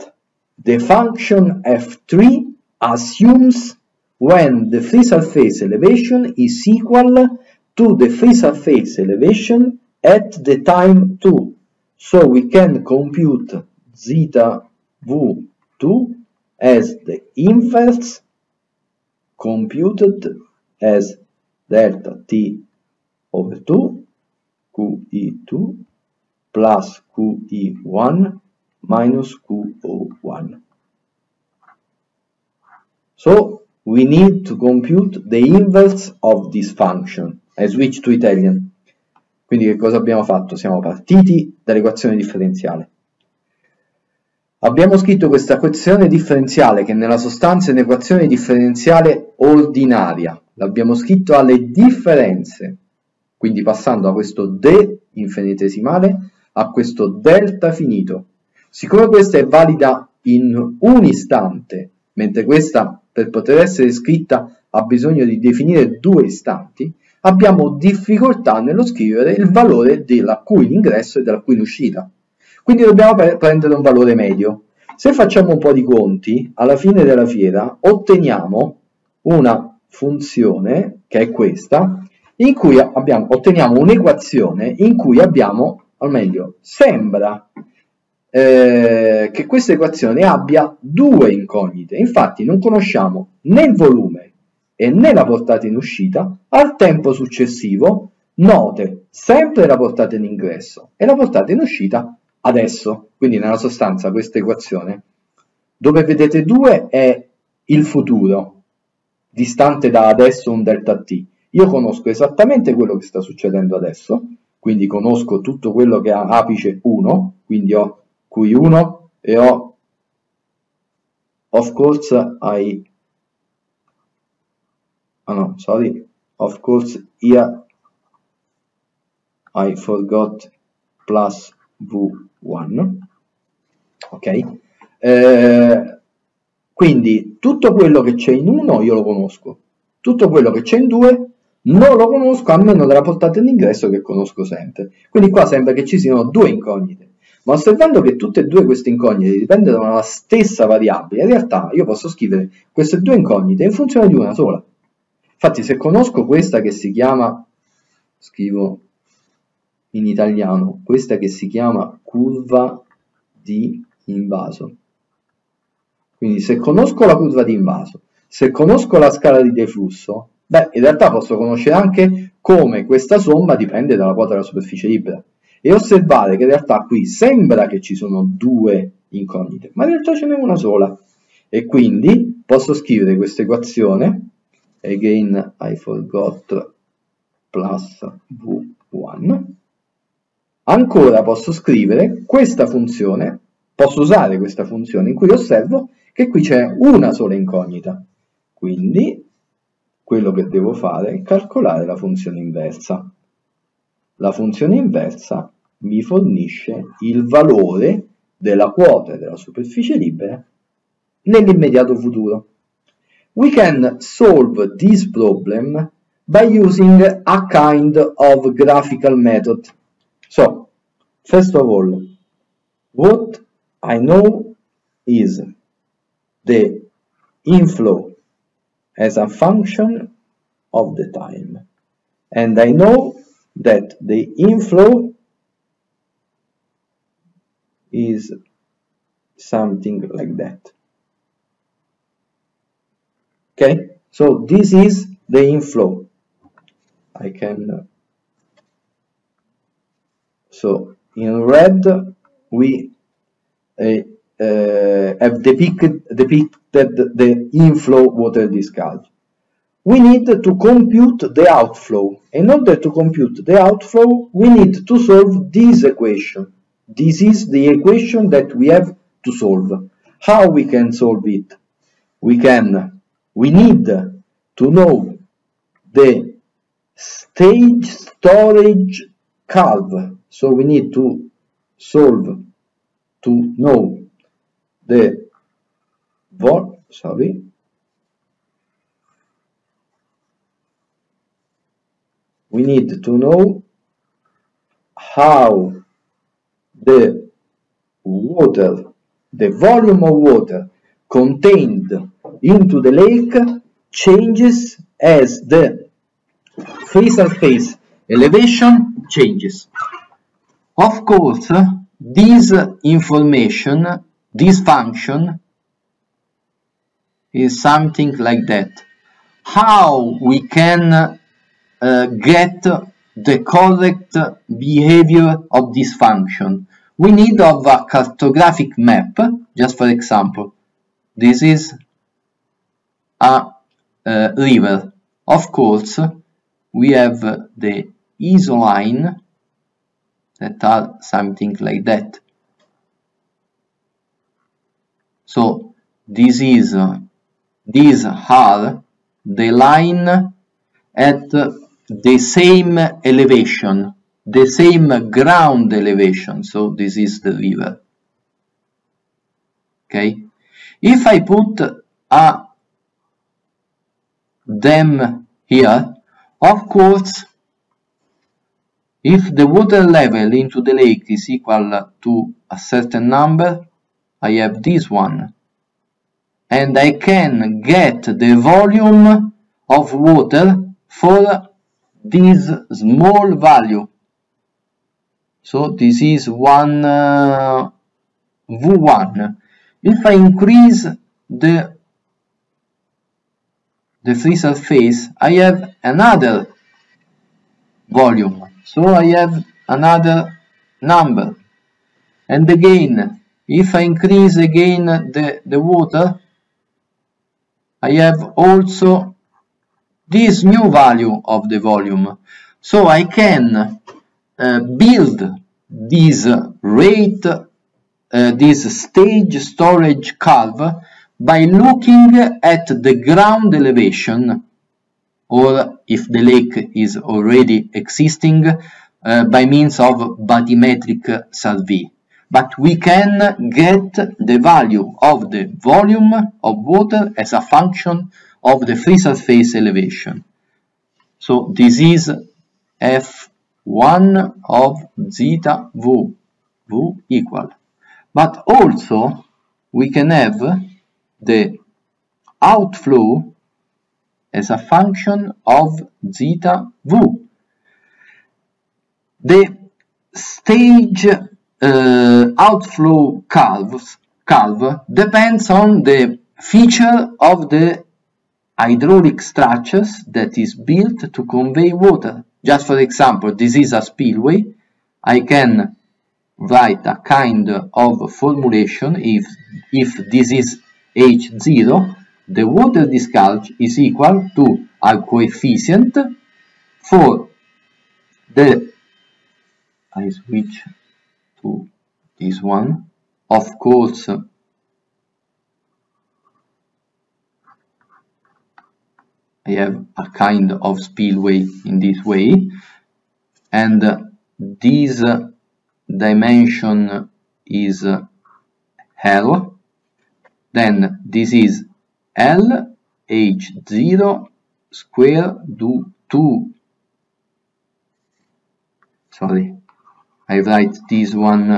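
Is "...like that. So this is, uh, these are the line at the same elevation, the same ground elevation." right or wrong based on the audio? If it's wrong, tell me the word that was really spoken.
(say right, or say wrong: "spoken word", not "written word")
right.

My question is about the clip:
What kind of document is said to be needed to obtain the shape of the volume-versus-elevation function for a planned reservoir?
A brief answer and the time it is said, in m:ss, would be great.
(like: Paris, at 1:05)
cartographic map, at 5:27.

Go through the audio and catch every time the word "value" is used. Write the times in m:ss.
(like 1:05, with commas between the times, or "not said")
6:23, 6:50, 7:14.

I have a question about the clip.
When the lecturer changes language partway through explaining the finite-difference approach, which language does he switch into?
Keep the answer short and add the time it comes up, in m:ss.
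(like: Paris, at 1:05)
Italian, at 0:38.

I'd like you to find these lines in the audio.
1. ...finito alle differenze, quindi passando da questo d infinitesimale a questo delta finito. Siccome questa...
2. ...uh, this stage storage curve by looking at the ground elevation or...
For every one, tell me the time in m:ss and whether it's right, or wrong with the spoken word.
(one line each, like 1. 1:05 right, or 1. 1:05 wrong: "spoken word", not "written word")
1. 0:50 wrong: "scritto", not "finito"
2. 6:57 right.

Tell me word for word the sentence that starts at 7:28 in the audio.
But also we can have the outflow as a function of zeta V.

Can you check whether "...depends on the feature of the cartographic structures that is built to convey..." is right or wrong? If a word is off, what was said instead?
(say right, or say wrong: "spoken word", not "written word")
wrong: "hydraulic", not "cartographic".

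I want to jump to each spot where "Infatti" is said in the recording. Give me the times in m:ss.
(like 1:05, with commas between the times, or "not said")
1:31, 2:35.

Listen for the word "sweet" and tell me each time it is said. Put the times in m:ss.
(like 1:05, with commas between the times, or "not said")
not said.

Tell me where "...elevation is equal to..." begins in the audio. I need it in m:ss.
0:05.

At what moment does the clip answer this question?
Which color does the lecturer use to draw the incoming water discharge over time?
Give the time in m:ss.
4:11.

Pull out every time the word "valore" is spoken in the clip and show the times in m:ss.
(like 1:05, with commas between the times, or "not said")
1:09, 1:13, 3:27.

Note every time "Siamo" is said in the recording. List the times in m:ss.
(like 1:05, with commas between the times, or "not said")
0:40.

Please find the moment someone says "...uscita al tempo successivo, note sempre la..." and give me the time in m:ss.
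1:35.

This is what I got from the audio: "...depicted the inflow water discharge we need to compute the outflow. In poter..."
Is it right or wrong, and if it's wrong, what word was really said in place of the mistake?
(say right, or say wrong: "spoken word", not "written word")
wrong: "order", not "poter".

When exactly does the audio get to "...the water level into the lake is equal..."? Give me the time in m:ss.
6:09.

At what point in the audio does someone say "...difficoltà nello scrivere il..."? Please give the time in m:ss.
1:07.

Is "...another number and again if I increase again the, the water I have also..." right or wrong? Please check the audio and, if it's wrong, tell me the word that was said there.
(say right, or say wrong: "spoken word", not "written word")
right.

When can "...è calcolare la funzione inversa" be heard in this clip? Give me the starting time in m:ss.
3:21.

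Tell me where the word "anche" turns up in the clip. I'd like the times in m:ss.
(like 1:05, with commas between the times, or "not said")
2:51.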